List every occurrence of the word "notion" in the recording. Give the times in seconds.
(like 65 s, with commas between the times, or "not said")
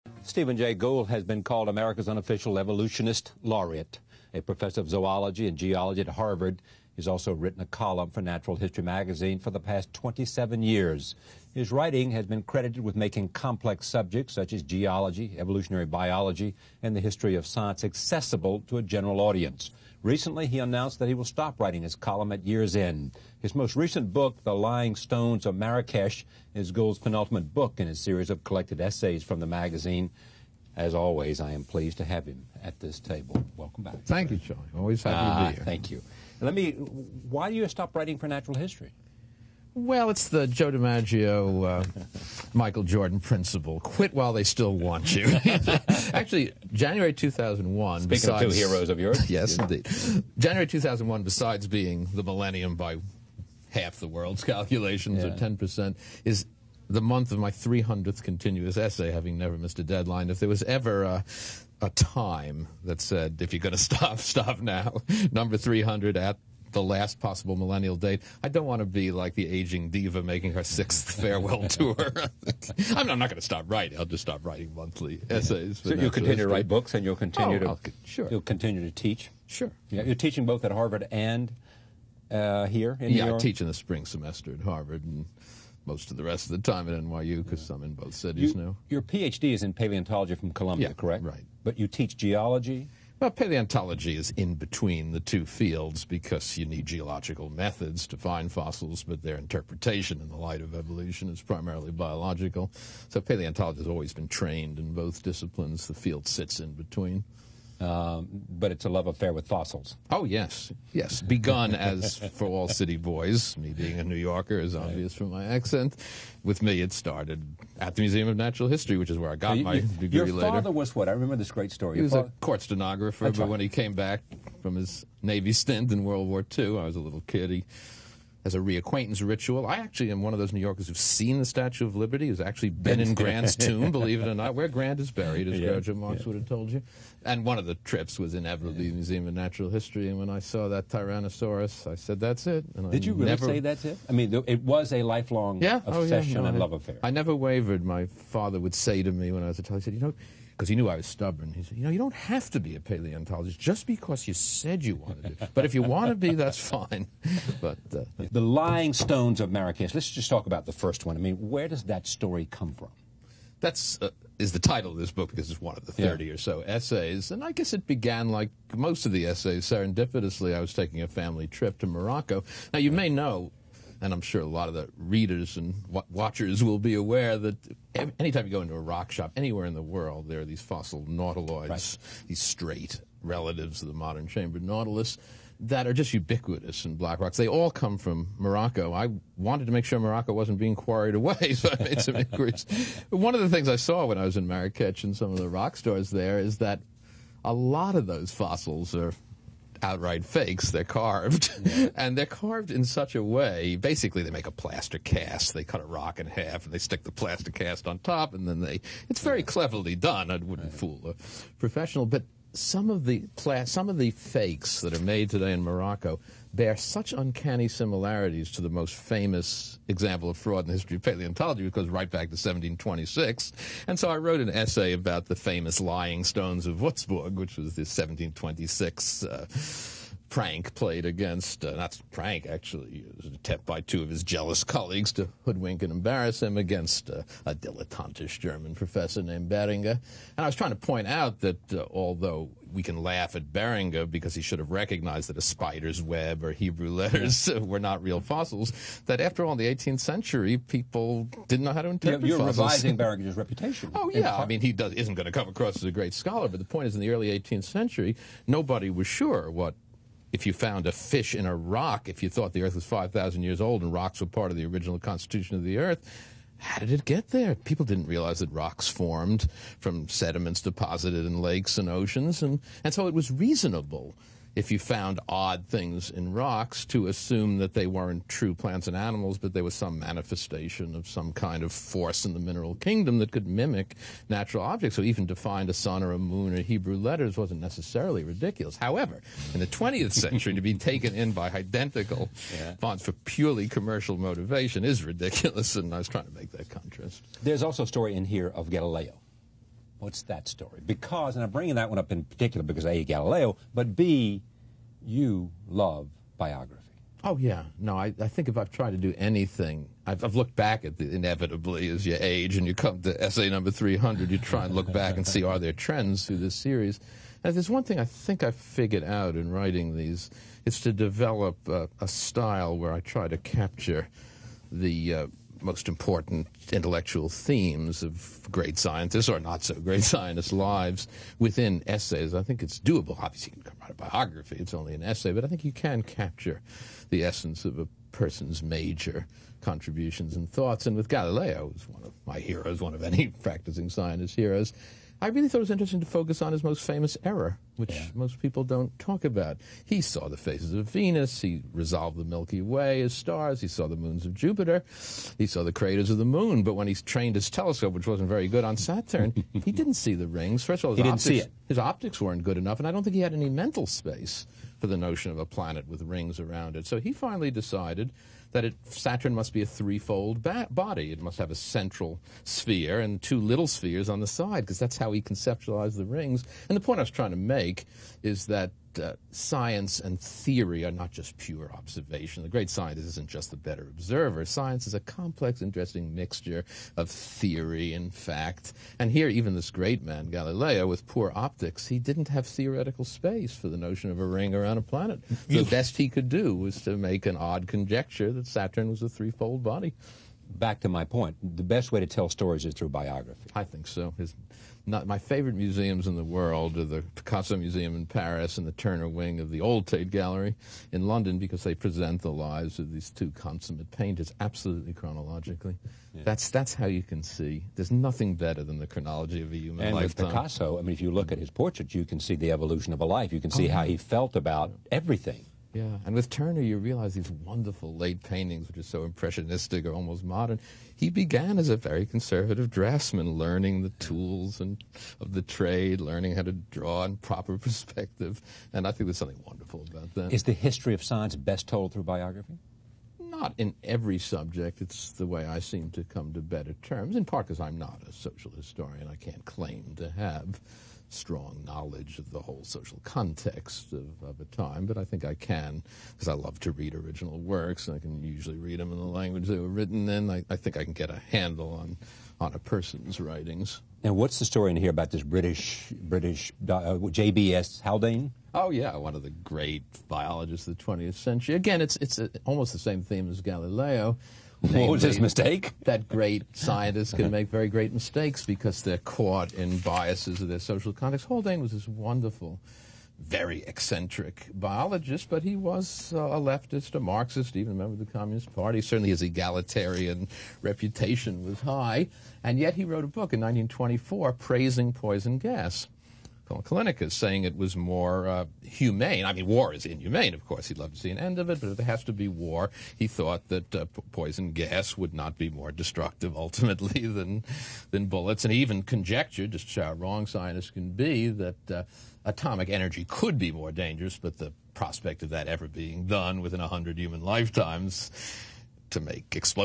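364 s, 393 s.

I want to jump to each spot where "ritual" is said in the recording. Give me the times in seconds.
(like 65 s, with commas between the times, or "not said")
129 s.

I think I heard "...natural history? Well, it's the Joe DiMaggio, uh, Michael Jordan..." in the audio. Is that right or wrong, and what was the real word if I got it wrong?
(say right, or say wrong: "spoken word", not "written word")
right.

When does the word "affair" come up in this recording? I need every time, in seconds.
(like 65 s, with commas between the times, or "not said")
109 s, 146 s.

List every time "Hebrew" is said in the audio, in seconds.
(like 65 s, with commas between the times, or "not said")
246 s, 286 s.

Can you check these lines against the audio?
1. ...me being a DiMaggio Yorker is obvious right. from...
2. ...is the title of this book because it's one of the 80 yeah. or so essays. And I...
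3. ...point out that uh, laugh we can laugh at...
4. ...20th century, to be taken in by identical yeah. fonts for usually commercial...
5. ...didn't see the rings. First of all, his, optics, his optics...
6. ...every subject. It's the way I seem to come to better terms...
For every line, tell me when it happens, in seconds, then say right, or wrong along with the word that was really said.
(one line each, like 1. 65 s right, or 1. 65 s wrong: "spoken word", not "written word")
1. 113 s wrong: "New", not "DiMaggio"
2. 164 s wrong: "30", not "80"
3. 240 s wrong: "although", not "laugh"
4. 289 s wrong: "purely", not "usually"
5. 359 s right
6. 443 s right.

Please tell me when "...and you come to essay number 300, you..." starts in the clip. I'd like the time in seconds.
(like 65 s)
312 s.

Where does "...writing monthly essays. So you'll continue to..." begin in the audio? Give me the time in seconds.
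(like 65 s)
74 s.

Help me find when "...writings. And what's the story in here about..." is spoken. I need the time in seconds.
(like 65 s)
463 s.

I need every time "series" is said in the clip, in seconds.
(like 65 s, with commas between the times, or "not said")
28 s, 316 s.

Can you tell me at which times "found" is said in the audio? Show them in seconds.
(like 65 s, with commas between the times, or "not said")
260 s, 274 s.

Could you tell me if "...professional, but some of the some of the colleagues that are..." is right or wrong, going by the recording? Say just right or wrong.
wrong.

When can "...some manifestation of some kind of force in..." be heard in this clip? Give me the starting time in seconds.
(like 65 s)
279 s.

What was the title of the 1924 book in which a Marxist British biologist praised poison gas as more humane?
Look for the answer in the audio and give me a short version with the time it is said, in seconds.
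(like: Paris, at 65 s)
Callinicus, at 496 s.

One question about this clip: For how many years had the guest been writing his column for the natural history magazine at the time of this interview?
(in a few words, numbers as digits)
27.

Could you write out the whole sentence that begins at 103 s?
So paleontology has always been trained in both disciplines.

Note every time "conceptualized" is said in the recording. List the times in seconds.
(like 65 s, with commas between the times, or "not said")
375 s.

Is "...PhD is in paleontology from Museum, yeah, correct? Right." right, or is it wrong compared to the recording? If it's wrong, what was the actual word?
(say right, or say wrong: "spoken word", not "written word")
wrong: "Columbia", not "Museum".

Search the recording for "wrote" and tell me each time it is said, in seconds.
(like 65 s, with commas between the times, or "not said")
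224 s, 492 s.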